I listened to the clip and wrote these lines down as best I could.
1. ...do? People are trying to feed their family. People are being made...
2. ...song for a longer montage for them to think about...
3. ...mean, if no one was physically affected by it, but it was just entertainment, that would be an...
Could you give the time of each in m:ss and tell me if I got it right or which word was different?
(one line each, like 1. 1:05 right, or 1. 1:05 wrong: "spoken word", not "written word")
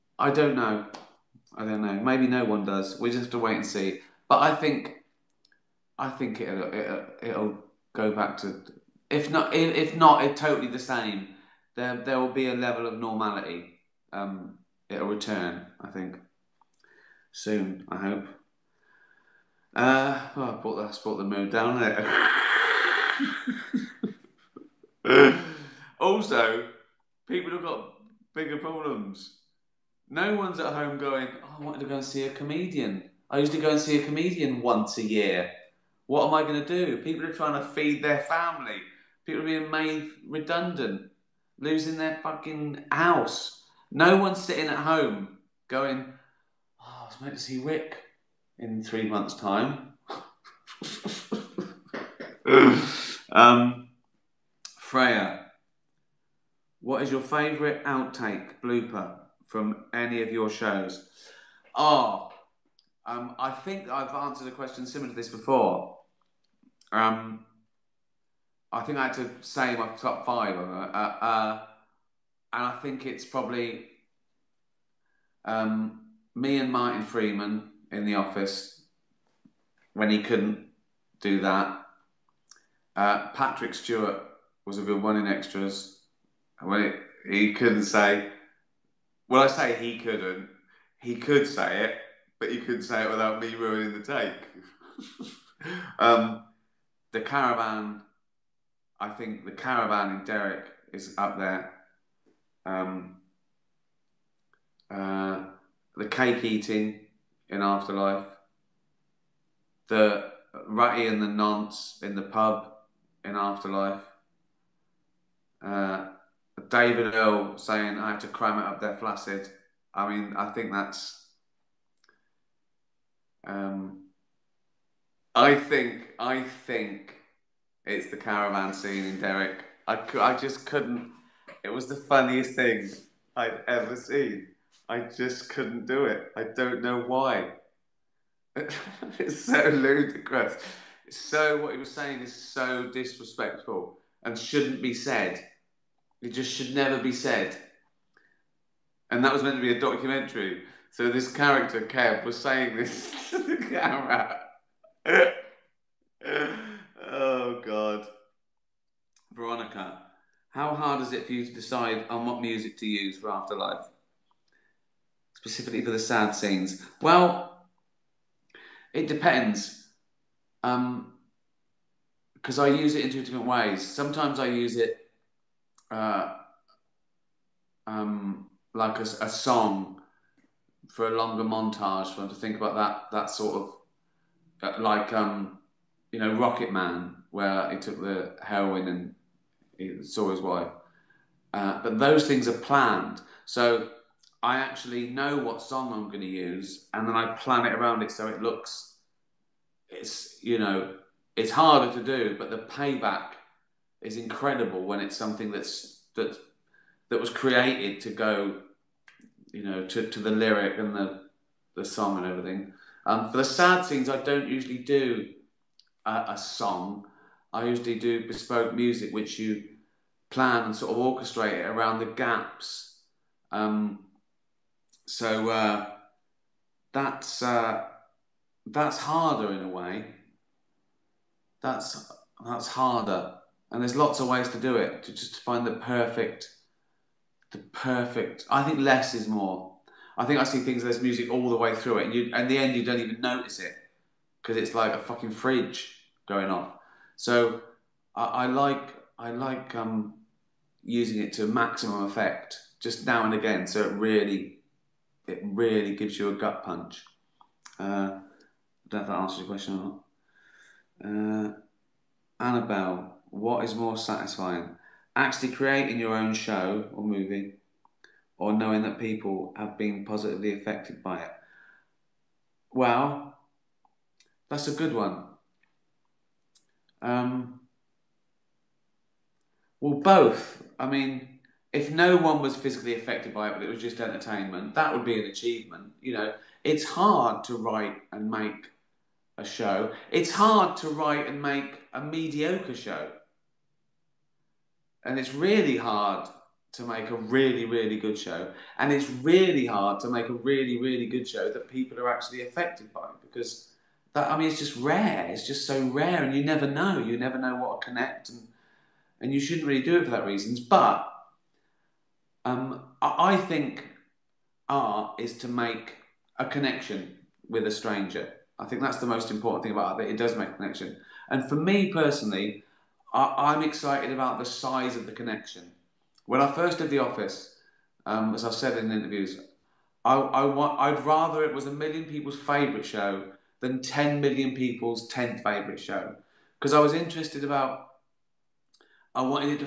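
1. 0:36 right
2. 2:59 right
3. 4:40 right.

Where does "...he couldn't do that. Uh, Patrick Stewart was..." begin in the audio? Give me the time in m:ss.
1:20.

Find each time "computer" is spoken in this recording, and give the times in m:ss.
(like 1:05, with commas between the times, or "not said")
not said.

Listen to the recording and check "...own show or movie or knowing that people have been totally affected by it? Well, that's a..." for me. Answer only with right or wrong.
wrong.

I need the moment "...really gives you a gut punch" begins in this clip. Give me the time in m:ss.
4:15.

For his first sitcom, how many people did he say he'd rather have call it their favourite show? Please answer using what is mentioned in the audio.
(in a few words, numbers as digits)
1 million.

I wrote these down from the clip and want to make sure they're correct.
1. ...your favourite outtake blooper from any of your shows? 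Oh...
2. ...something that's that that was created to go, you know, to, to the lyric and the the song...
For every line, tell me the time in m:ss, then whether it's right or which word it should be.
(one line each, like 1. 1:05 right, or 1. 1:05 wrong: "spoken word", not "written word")
1. 0:57 right
2. 3:25 right.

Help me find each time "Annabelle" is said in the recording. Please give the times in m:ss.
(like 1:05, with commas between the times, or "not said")
4:22.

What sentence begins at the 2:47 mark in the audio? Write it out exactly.
Well, it depends, because um, I use it in two different ways.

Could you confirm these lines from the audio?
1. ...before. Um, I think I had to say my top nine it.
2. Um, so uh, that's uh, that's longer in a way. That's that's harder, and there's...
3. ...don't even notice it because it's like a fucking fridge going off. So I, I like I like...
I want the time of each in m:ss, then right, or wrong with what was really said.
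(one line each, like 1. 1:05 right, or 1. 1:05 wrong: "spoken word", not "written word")
1. 1:05 wrong: "five", not "nine"
2. 3:43 wrong: "harder", not "longer"
3. 4:02 right.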